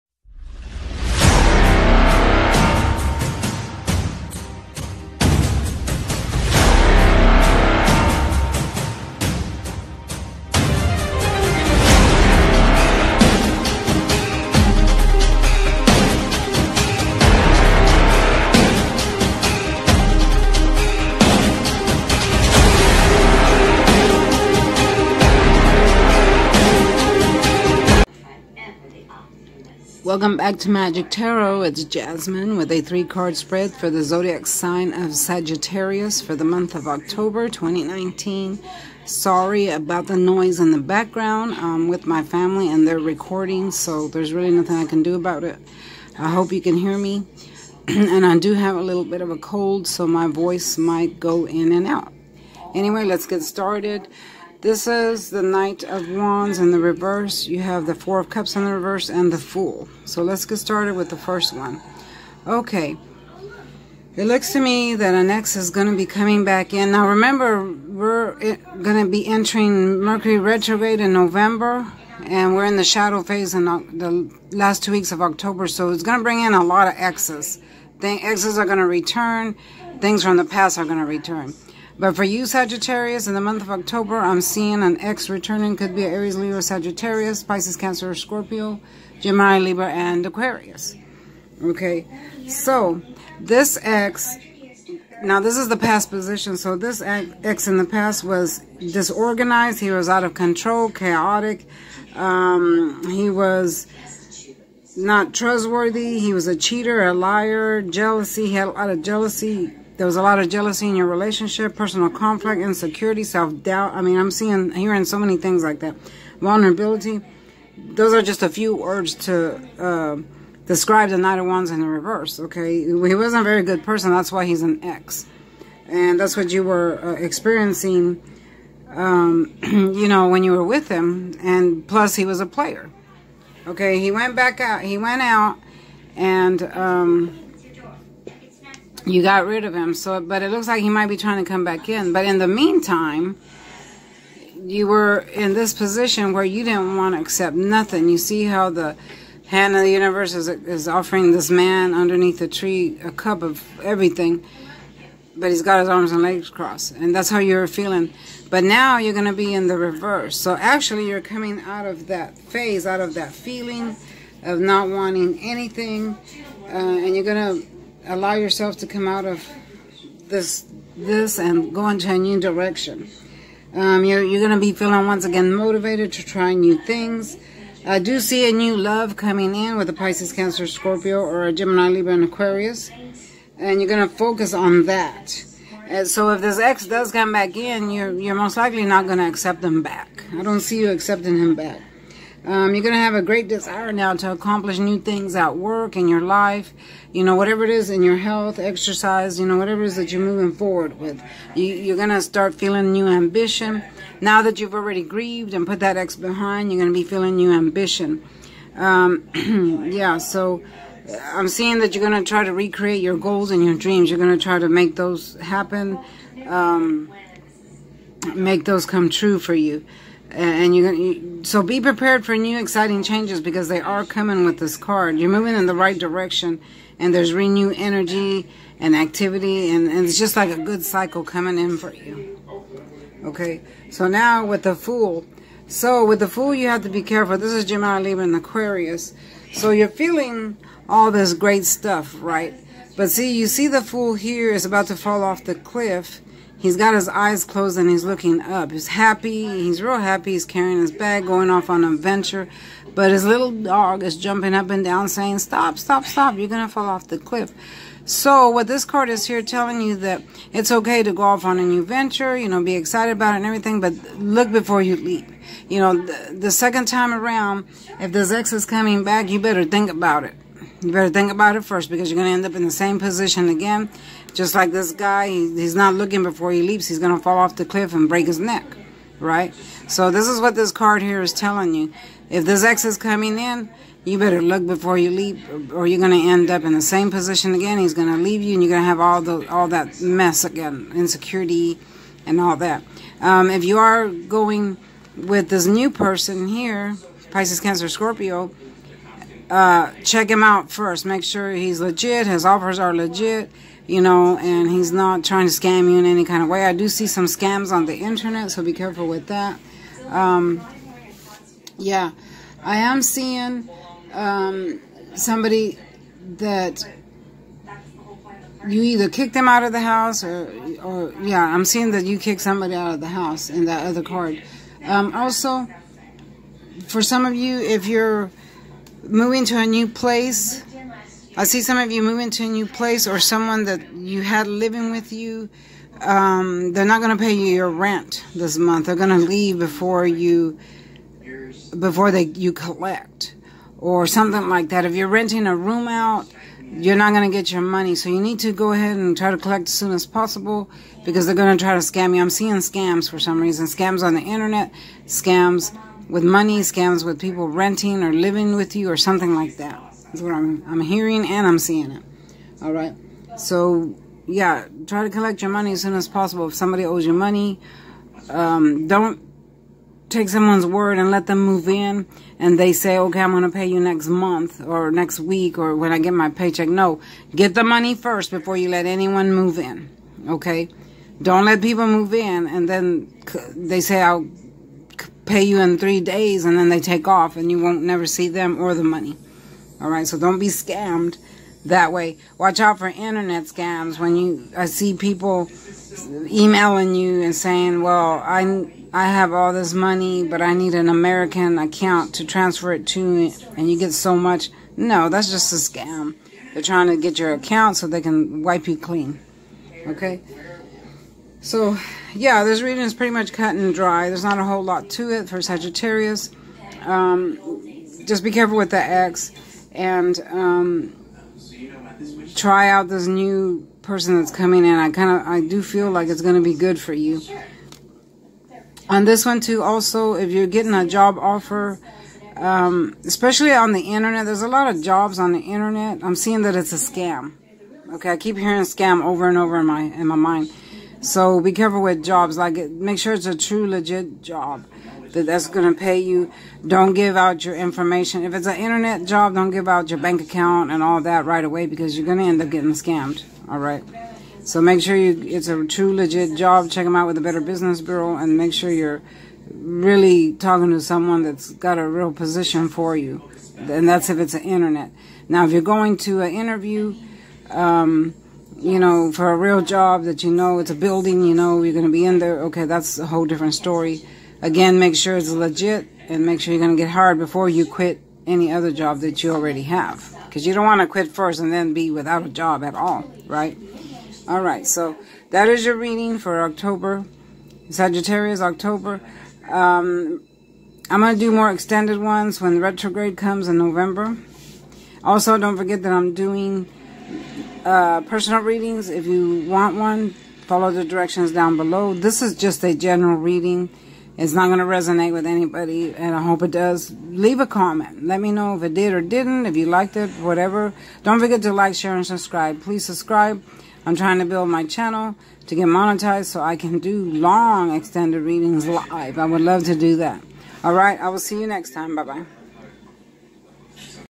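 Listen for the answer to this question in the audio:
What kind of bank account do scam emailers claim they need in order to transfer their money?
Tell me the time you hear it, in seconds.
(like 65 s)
400 s.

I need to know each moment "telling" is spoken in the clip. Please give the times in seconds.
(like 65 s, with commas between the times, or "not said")
259 s, 281 s.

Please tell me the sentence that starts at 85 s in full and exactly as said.
Could be Aries, Leo, Sagittarius, Pisces, Cancer, Scorpio, Gemini, Libra, and Aquarius.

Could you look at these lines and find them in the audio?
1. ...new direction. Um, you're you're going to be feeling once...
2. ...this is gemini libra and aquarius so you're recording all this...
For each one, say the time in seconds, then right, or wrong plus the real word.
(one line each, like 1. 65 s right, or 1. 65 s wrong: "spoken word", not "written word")
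1. 172 s right
2. 237 s wrong: "feeling", not "recording".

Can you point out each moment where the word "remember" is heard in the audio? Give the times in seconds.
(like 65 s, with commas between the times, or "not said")
67 s.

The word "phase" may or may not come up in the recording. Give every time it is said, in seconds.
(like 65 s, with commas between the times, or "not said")
73 s, 162 s.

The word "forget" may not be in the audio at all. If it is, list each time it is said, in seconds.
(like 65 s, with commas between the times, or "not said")
495 s, 511 s.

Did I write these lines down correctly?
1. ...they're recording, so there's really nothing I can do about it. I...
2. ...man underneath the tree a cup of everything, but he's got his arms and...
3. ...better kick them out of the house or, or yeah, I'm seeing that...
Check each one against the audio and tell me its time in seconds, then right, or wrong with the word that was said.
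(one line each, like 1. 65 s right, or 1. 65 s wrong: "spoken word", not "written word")
1. 42 s right
2. 151 s right
3. 318 s wrong: "either", not "better".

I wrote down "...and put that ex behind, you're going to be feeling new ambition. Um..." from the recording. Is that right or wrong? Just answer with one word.
right.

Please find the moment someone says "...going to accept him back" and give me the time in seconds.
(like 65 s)
189 s.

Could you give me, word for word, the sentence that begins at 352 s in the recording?
I'm seeing scams for some reason.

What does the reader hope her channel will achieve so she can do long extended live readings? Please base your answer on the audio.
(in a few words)
Get monetized.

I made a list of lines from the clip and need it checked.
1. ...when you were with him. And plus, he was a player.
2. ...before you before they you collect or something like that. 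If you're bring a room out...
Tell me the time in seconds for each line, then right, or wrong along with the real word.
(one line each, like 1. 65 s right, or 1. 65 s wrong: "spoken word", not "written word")
1. 130 s right
2. 339 s wrong: "renting", not "bring".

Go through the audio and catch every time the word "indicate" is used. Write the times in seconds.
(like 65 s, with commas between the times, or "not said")
not said.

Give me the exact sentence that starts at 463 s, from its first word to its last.
And that's if it's an internet.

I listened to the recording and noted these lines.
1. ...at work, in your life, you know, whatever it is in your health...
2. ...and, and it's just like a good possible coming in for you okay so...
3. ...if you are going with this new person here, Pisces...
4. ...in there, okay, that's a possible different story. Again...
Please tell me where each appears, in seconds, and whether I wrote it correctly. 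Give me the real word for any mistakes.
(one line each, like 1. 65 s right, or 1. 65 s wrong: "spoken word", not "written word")
1. 195 s right
2. 229 s wrong: "cycle", not "possible"
3. 293 s right
4. 472 s wrong: "whole", not "possible".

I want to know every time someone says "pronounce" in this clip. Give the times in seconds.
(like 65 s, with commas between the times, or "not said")
not said.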